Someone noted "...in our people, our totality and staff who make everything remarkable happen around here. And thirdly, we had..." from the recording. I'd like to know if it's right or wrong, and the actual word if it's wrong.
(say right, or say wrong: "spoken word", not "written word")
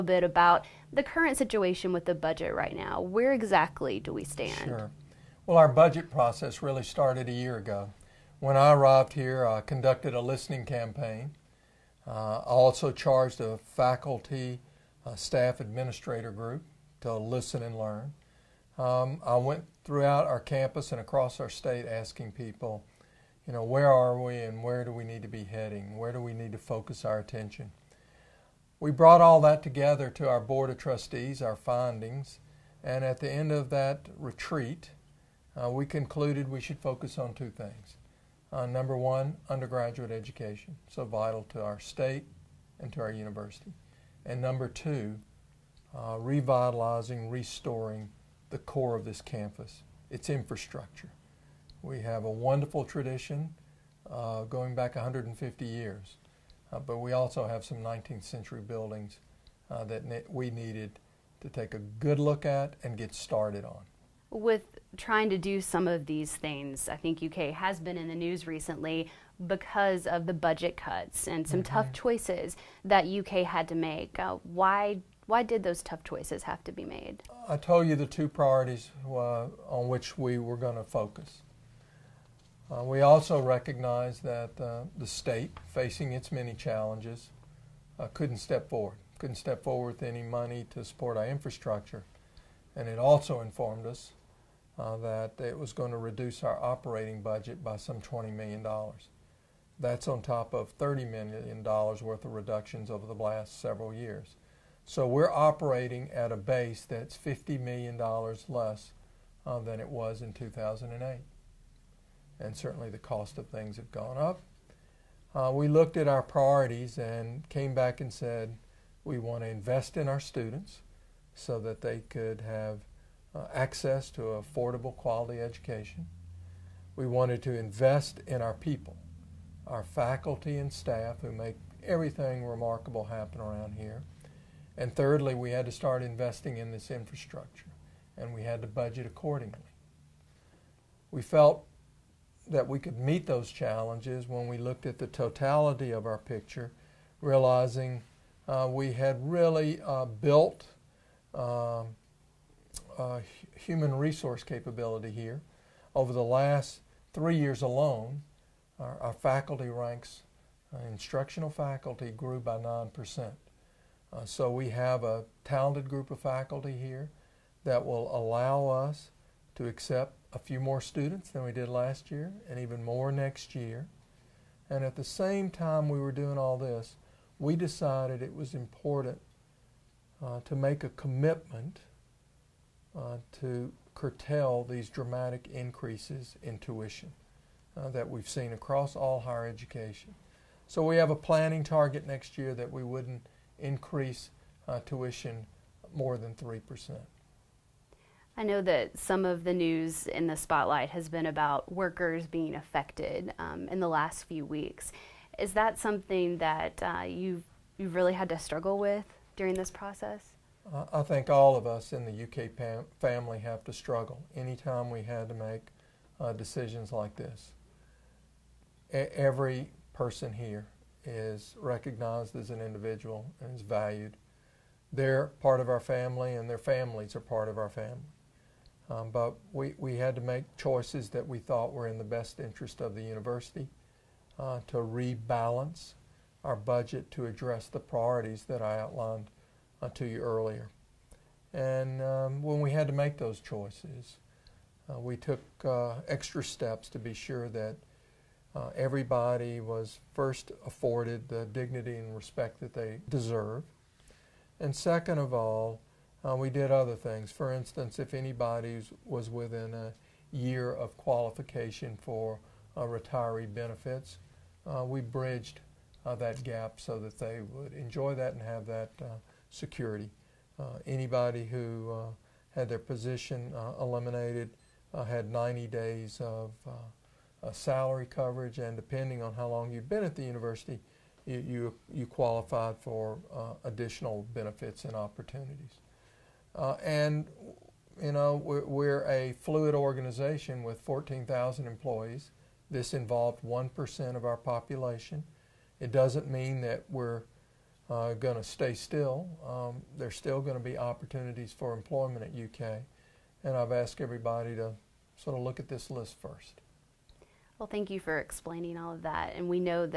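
wrong: "faculty", not "totality".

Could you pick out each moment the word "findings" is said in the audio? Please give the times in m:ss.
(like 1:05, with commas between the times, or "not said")
0:31.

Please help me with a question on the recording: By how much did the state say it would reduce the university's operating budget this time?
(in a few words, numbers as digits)
$20 million.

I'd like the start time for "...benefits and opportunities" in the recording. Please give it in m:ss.
4:44.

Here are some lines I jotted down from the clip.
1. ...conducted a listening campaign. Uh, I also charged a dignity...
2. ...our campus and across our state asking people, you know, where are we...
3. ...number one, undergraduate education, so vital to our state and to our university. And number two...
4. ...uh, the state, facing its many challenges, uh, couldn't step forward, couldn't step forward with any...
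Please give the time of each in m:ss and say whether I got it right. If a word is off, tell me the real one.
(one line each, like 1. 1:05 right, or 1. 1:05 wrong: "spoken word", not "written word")
1. 0:09 wrong: "faculty", not "dignity"
2. 0:20 right
3. 0:38 right
4. 1:24 right.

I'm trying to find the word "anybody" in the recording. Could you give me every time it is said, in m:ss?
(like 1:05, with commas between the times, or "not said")
4:18, 4:30.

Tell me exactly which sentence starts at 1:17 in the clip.
I told you the two priorities uh, on which we were going to focus.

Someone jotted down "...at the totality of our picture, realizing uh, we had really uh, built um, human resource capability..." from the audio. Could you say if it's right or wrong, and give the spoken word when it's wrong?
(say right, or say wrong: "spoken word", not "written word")
right.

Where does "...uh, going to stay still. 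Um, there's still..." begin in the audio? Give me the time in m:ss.
4:57.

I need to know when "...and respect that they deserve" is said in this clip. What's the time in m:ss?
4:11.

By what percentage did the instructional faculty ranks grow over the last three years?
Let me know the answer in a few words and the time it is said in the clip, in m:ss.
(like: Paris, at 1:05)
9%, at 2:42.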